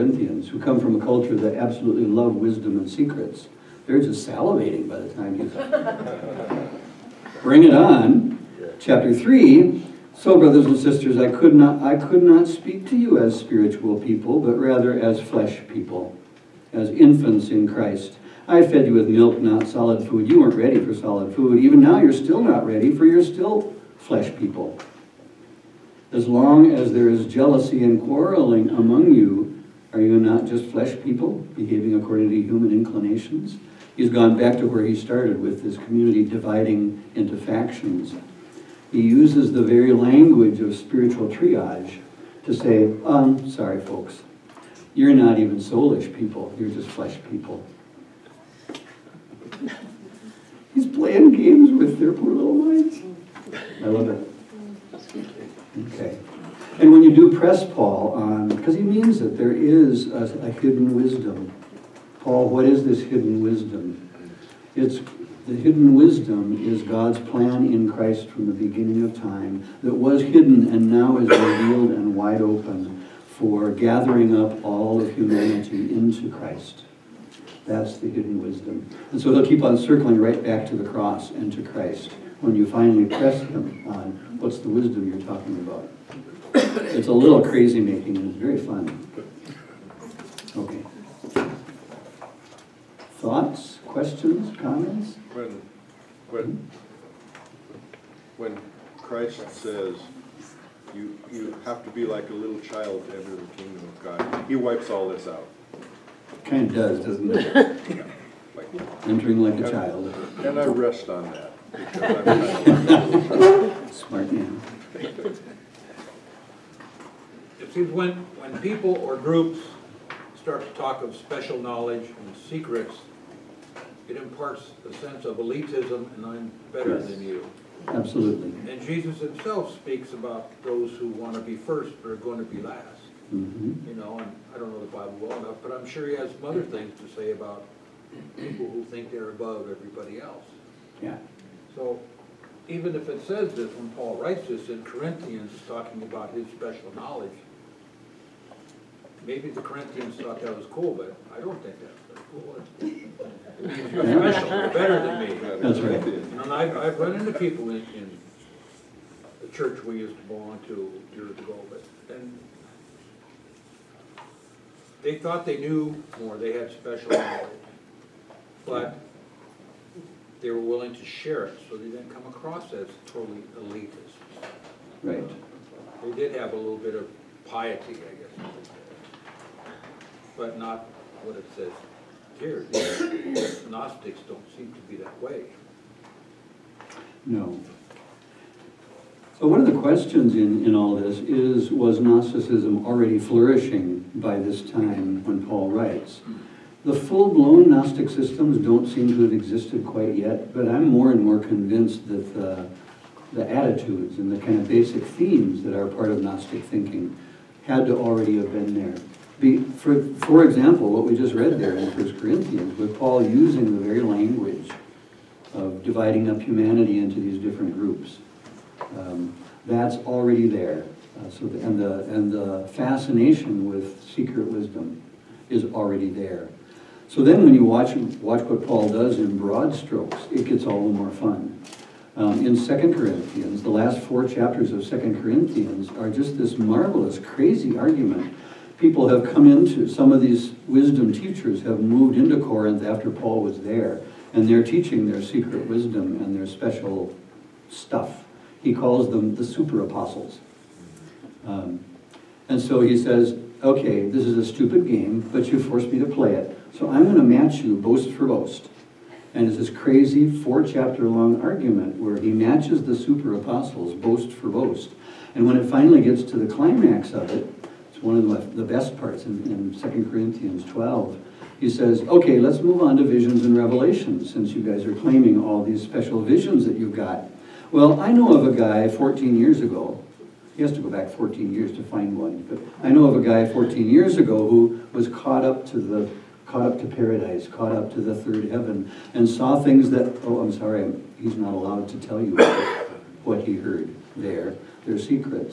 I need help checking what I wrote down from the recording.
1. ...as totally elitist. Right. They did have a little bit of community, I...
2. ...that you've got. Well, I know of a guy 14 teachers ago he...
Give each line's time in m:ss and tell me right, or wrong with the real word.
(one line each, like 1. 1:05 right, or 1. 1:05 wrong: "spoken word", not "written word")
1. 2:52 wrong: "piety", not "community"
2. 4:36 wrong: "years", not "teachers".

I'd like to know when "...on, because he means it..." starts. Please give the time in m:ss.
0:58.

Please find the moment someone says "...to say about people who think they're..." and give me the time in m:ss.
2:16.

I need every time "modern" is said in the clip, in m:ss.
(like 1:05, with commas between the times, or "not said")
not said.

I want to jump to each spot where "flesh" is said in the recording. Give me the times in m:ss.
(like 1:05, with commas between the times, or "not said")
0:15, 0:23, 0:30, 0:46.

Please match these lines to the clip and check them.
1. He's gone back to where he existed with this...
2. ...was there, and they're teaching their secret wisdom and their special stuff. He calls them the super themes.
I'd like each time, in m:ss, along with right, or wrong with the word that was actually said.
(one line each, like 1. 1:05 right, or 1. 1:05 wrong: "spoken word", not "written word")
1. 0:33 wrong: "started", not "existed"
2. 4:03 wrong: "apostles", not "themes".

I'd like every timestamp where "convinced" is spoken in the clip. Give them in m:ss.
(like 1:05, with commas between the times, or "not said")
3:21.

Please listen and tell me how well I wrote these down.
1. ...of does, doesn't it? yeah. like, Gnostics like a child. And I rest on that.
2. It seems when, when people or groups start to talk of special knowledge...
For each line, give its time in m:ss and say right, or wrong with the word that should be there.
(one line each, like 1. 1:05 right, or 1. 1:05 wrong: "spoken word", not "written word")
1. 1:46 wrong: "Entering", not "Gnostics"
2. 1:57 right.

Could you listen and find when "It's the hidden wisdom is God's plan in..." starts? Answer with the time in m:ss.
1:04.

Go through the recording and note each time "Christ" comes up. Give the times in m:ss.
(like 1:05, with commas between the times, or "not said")
0:17, 1:07, 1:16, 1:21, 1:38.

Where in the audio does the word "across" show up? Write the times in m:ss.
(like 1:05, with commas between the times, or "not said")
2:52.